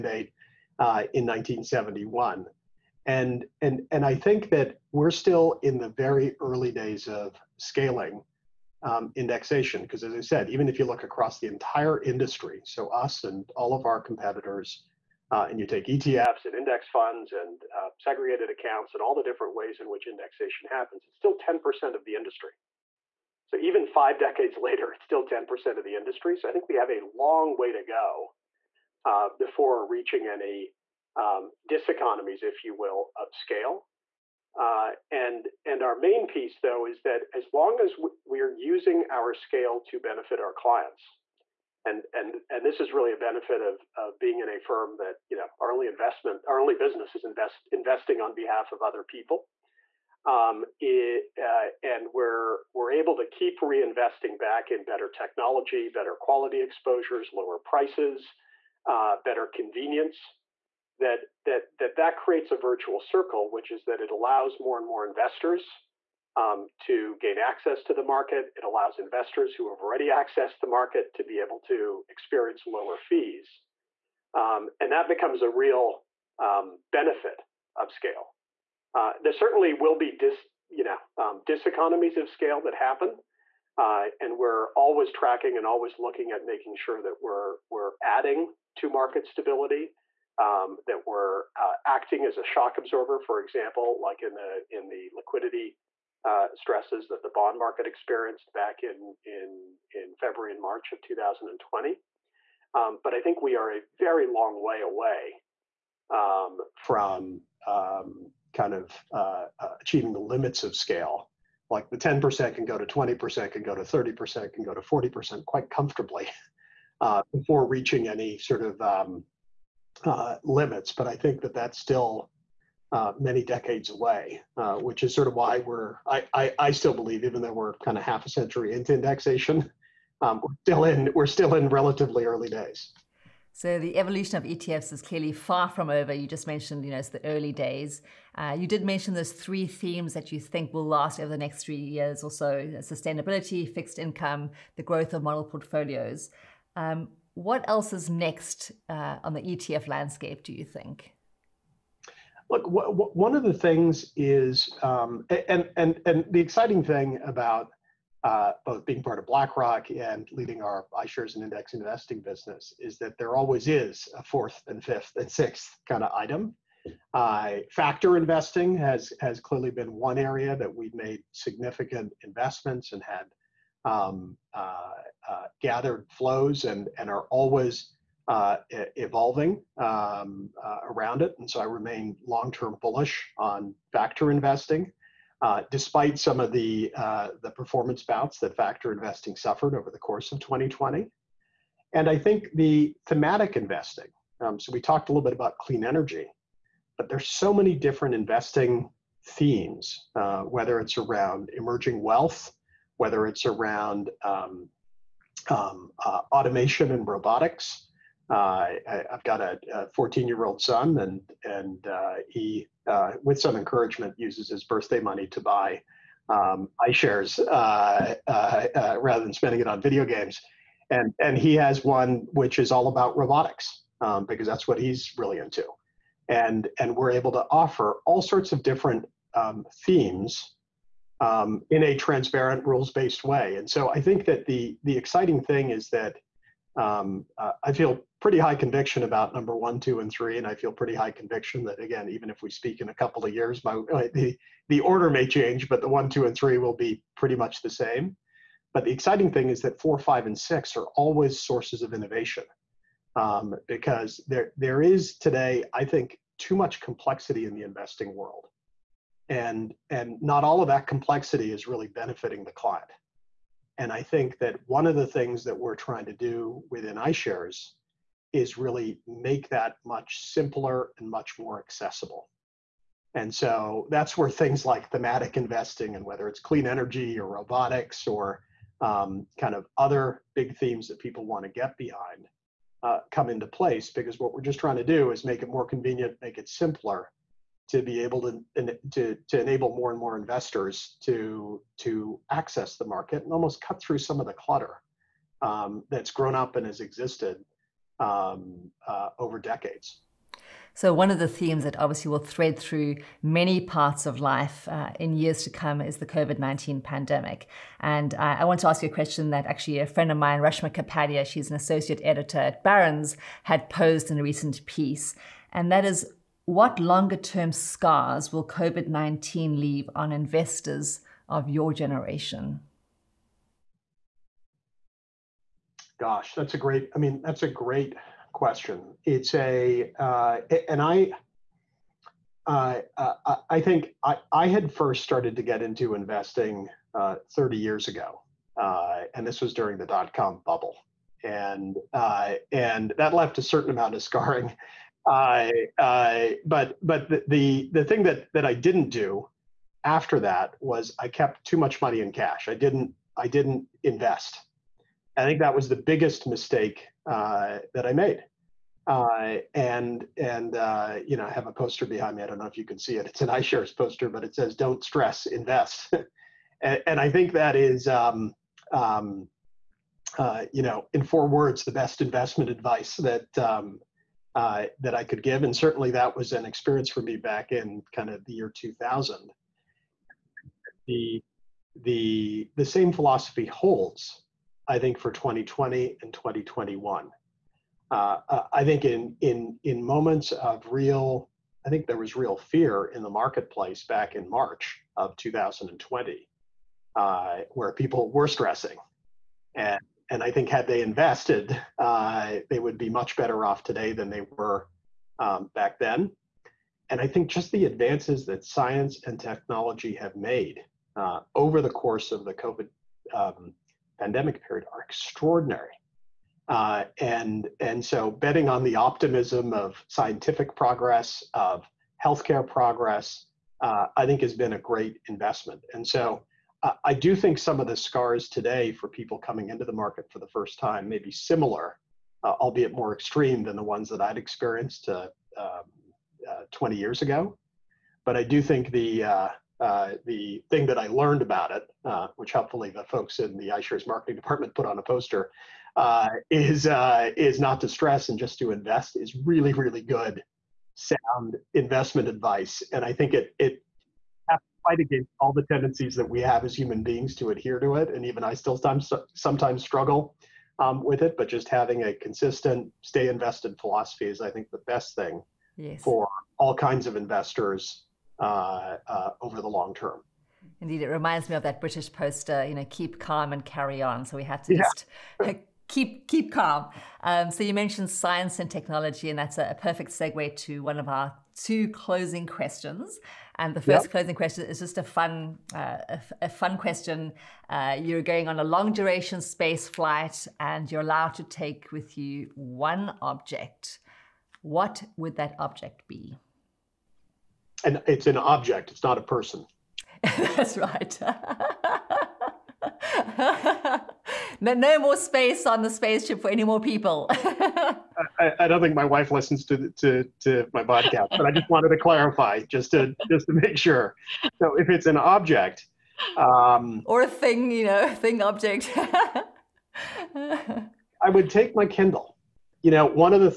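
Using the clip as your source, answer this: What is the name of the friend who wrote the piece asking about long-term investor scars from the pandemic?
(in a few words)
Reshma Kapadia.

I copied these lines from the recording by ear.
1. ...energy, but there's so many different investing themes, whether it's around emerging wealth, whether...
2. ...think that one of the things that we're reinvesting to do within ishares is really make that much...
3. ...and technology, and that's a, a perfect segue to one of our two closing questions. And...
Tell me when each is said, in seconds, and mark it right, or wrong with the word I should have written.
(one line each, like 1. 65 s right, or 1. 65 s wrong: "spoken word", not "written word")
1. 195 s right
2. 264 s wrong: "trying", not "reinvesting"
3. 478 s right.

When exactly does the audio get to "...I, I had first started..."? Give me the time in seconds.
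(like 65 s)
334 s.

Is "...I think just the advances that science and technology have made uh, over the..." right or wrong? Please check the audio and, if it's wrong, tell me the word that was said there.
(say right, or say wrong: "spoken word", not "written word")
right.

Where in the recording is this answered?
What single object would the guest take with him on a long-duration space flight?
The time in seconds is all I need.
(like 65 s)
521 s.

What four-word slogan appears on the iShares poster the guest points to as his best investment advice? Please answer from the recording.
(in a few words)
Don't stress, invest.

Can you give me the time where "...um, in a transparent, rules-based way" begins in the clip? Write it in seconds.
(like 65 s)
231 s.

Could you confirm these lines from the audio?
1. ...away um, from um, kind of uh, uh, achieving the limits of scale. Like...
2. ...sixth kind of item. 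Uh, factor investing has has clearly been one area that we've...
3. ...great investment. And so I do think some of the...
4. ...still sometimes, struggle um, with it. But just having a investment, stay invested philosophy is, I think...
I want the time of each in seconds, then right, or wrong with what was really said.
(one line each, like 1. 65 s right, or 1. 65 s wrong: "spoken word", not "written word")
1. 104 s right
2. 165 s right
3. 424 s right
4. 458 s wrong: "consistent", not "investment".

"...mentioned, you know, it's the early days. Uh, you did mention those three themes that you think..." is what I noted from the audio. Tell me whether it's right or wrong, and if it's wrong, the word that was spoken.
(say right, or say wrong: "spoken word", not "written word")
right.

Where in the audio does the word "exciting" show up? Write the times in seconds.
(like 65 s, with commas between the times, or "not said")
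156 s, 234 s, 248 s.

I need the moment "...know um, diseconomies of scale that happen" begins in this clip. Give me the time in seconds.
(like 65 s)
80 s.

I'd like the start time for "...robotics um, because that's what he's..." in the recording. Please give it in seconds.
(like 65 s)
223 s.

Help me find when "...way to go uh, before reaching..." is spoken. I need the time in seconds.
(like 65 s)
27 s.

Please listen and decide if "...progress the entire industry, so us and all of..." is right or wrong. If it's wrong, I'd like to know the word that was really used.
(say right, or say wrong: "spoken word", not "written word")
wrong: "across", not "progress".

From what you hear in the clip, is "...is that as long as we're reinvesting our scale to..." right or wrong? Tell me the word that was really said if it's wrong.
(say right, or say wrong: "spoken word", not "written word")
wrong: "using", not "reinvesting".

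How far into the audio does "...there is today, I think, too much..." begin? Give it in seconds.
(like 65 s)
254 s.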